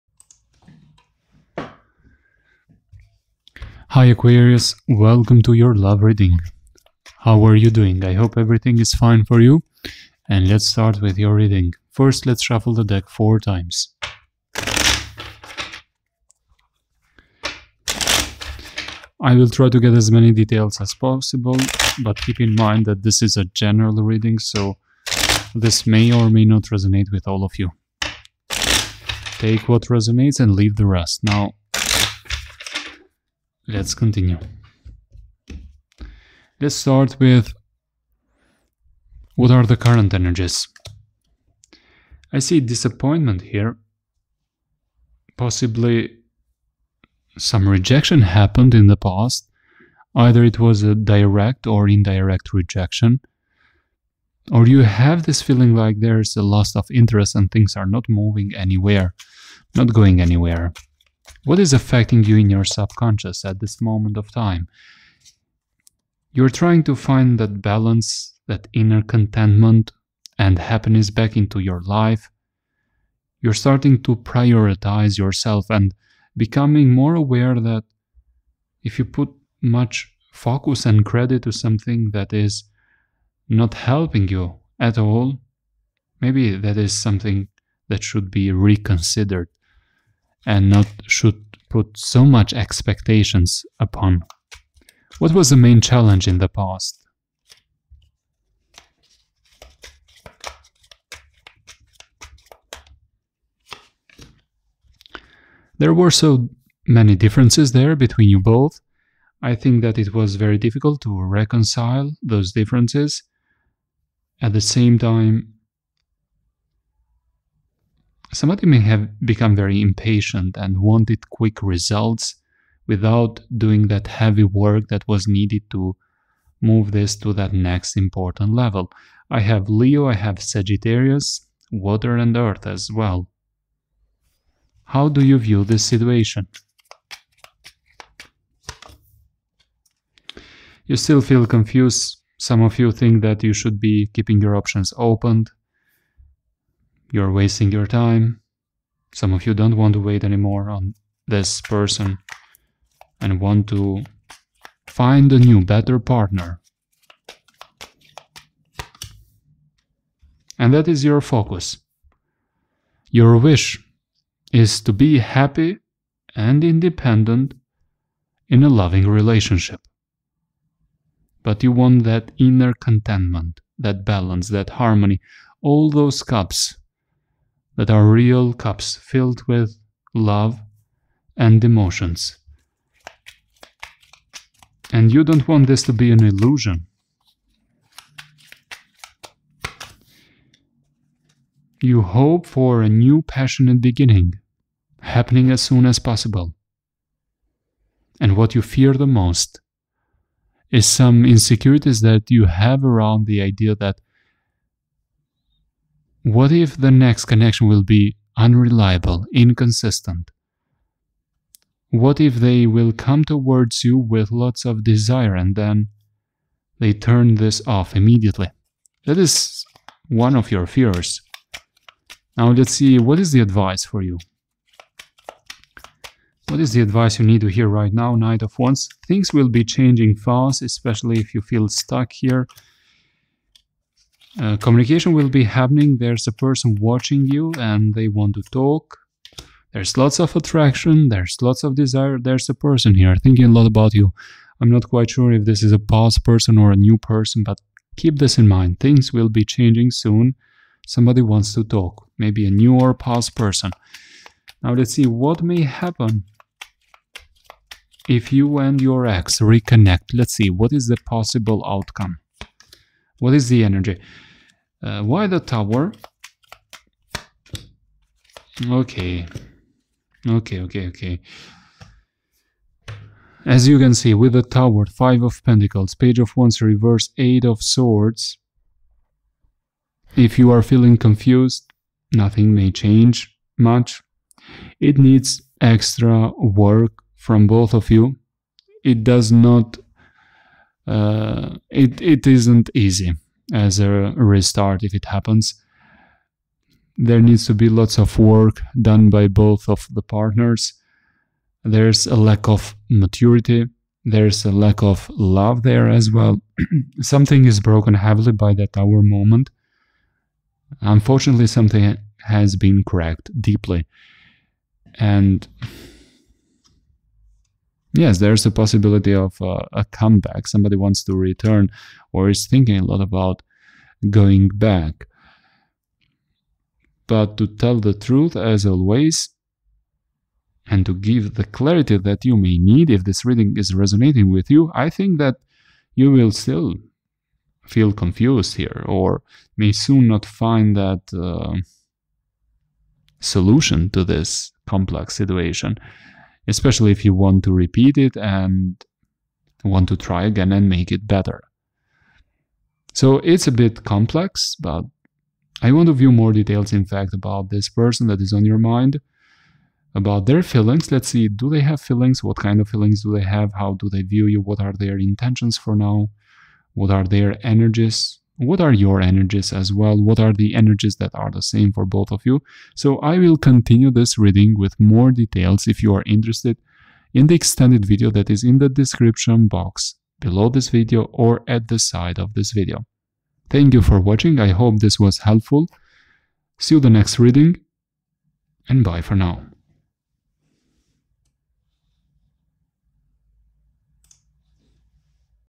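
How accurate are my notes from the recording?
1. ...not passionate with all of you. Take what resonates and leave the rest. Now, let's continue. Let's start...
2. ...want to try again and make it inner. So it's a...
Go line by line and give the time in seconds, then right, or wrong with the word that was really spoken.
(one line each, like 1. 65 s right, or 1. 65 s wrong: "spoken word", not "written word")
1. 26 s wrong: "resonate", not "passionate"
2. 349 s wrong: "better", not "inner".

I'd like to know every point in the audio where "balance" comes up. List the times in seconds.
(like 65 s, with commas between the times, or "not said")
67 s, 174 s.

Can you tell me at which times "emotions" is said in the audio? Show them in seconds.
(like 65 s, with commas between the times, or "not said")
181 s.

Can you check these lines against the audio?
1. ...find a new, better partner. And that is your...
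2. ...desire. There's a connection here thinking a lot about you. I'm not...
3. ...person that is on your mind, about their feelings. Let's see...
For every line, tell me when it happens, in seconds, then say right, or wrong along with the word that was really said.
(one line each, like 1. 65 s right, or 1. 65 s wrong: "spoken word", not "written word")
1. 154 s right
2. 241 s wrong: "person", not "connection"
3. 357 s right.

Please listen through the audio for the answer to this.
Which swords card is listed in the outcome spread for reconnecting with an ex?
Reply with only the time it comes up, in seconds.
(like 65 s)
277 s.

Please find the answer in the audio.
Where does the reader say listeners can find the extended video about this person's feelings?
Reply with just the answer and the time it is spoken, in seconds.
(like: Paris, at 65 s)
Description box, at 378 s.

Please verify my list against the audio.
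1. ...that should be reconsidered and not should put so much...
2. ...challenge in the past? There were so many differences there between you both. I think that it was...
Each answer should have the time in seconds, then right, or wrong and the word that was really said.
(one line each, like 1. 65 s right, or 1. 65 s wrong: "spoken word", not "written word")
1. 87 s right
2. 95 s right.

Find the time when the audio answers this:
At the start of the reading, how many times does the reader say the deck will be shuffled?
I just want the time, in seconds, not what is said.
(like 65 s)
13 s.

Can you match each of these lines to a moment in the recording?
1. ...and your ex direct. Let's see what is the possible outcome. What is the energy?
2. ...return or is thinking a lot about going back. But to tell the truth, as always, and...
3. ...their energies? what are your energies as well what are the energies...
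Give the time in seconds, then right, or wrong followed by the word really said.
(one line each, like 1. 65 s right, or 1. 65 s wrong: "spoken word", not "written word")
1. 258 s wrong: "reconnect", not "direct"
2. 321 s right
3. 367 s right.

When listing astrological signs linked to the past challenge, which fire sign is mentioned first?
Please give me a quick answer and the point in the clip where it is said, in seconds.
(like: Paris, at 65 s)
Leo, at 129 s.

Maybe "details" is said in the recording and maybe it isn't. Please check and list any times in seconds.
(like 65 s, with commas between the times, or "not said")
20 s, 356 s, 375 s.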